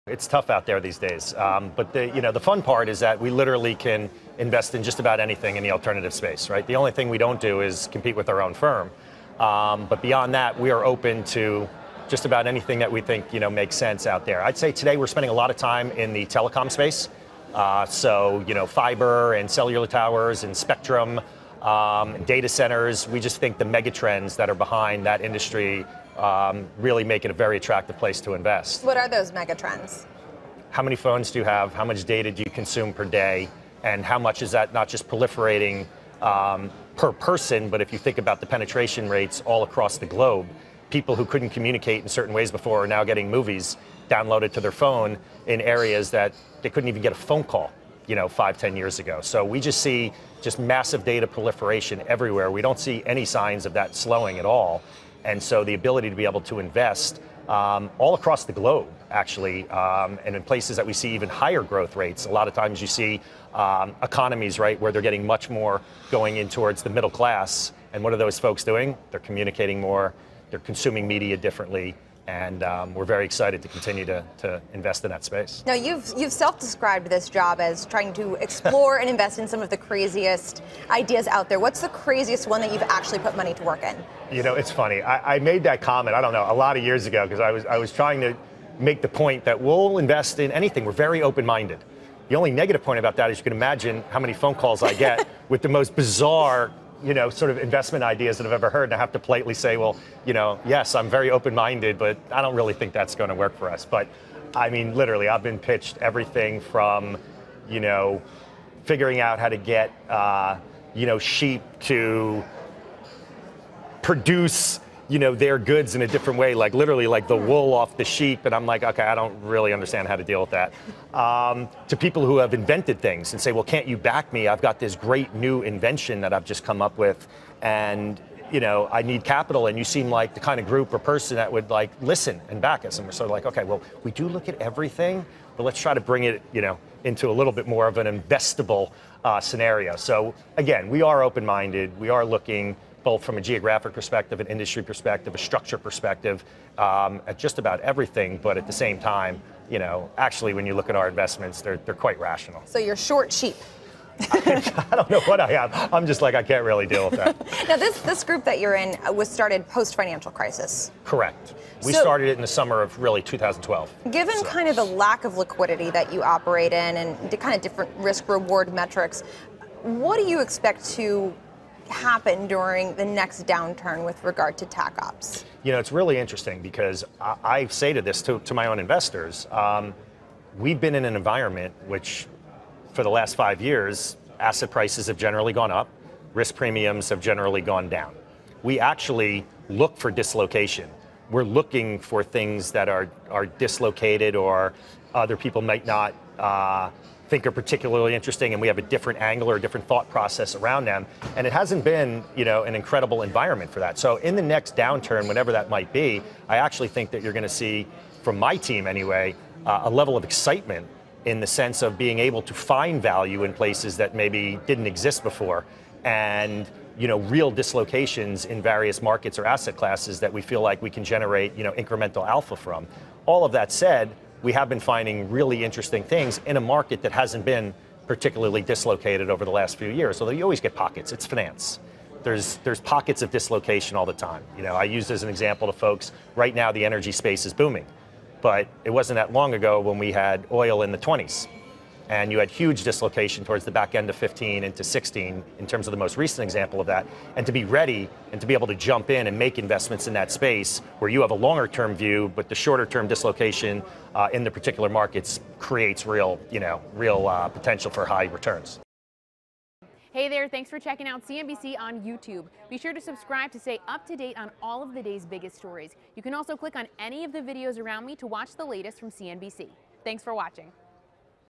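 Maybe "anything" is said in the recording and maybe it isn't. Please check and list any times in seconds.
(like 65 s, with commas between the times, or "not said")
5 s, 12 s, 90 s.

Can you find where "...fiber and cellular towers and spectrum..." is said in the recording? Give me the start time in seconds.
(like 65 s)
18 s.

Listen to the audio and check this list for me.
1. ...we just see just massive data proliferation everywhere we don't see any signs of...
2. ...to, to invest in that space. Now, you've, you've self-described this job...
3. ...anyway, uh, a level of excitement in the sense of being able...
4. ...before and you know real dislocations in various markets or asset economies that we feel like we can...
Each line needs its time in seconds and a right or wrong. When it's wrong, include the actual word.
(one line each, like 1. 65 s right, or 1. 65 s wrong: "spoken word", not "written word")
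1. 49 s right
2. 74 s right
3. 208 s right
4. 215 s wrong: "classes", not "economies".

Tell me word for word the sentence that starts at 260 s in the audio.
Hey there, thanks for checking out CNBC on YouTube.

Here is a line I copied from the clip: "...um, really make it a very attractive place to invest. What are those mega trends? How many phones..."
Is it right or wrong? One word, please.
right.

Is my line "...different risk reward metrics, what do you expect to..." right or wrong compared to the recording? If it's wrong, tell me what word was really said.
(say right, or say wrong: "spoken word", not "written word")
right.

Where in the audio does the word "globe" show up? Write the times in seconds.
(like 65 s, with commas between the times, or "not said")
40 s, 58 s.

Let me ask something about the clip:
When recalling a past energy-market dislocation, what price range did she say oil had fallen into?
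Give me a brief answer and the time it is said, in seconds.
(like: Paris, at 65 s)
The 20s, at 240 s.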